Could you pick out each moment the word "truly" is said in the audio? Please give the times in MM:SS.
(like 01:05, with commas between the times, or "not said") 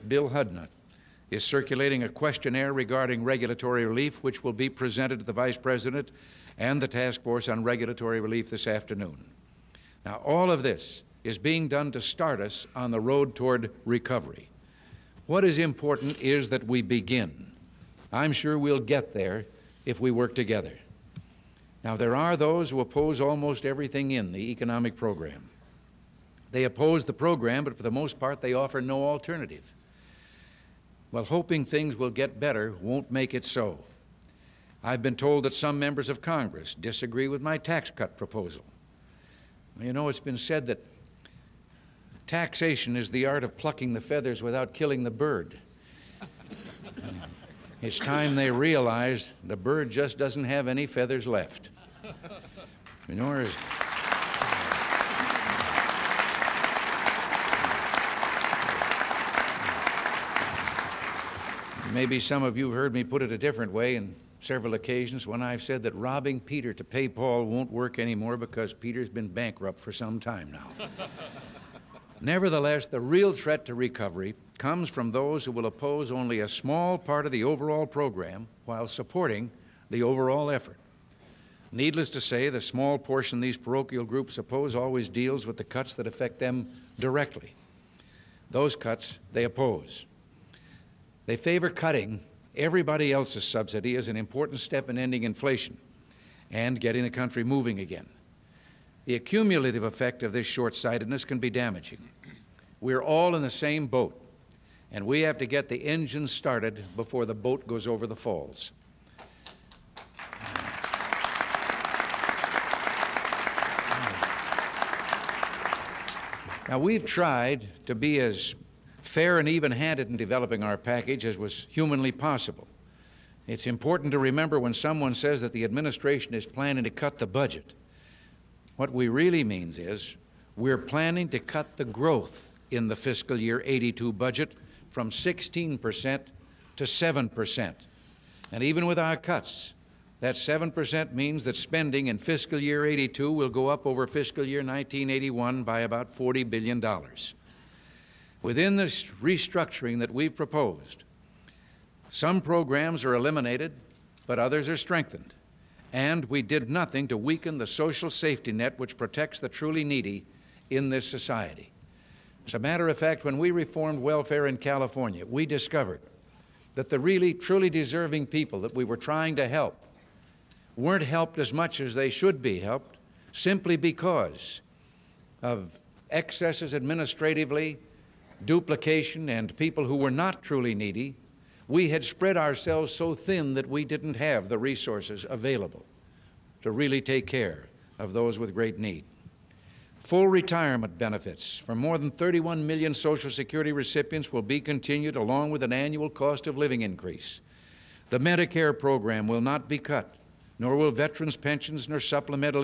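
02:39, 02:47, 03:00.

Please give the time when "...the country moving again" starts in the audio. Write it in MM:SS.
01:37.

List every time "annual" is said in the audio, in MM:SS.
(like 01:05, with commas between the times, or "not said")
03:15.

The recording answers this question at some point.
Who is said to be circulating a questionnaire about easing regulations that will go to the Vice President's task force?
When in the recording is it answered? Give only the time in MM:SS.
00:00.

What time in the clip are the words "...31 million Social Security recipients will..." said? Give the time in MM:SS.
03:12.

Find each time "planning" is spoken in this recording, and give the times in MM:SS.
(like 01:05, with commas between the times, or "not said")
02:06, 02:10.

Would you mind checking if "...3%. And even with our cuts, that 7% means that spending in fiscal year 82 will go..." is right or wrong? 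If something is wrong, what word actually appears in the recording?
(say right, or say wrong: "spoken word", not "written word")
wrong: "7", not "3".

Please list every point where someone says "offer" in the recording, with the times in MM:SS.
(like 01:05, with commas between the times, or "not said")
00:28.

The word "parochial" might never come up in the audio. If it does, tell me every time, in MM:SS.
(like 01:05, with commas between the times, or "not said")
01:23.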